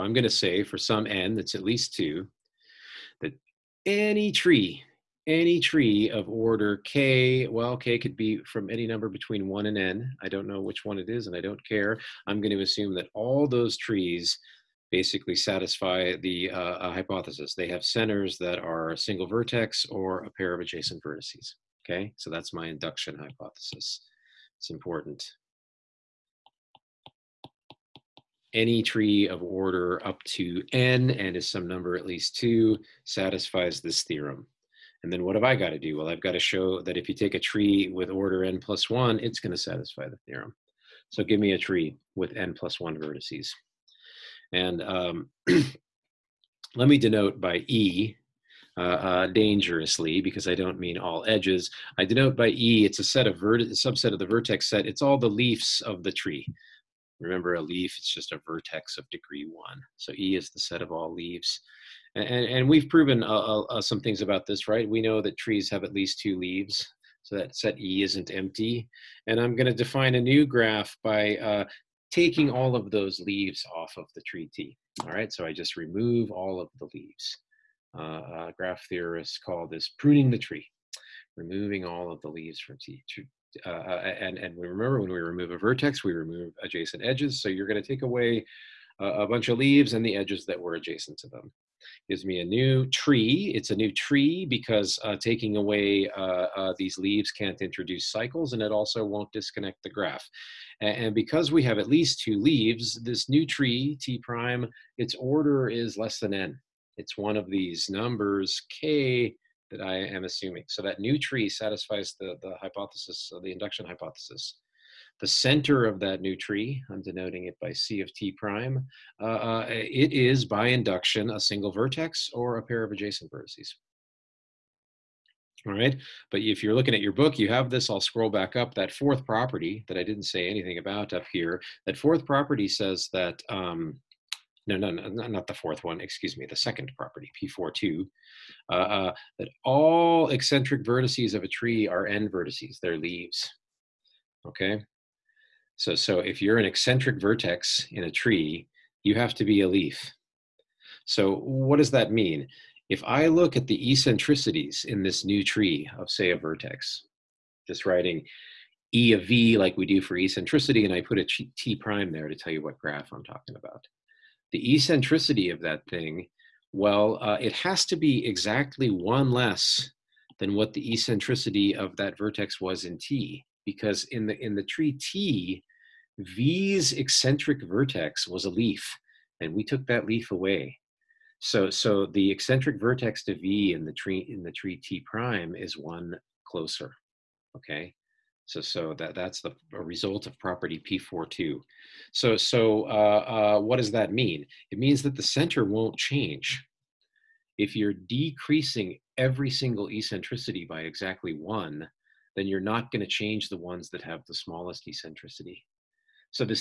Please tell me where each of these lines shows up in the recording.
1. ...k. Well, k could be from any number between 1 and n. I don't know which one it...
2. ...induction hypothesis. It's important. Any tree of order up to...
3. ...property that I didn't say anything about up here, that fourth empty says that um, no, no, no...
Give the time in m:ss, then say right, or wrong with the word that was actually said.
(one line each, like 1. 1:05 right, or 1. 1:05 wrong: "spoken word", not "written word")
1. 0:06 right
2. 0:22 right
3. 2:09 wrong: "property", not "empty".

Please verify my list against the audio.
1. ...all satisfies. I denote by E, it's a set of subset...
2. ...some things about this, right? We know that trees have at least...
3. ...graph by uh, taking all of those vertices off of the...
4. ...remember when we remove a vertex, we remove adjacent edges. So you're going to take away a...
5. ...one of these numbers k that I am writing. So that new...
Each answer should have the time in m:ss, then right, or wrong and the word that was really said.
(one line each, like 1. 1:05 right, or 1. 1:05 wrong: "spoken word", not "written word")
1. 0:50 wrong: "edges", not "satisfies"
2. 1:03 right
3. 1:10 wrong: "leaves", not "vertices"
4. 1:24 right
5. 1:47 wrong: "assuming", not "writing".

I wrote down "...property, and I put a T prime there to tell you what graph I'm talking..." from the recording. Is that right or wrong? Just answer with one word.
wrong.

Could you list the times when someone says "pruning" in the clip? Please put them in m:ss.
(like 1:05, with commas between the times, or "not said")
1:19.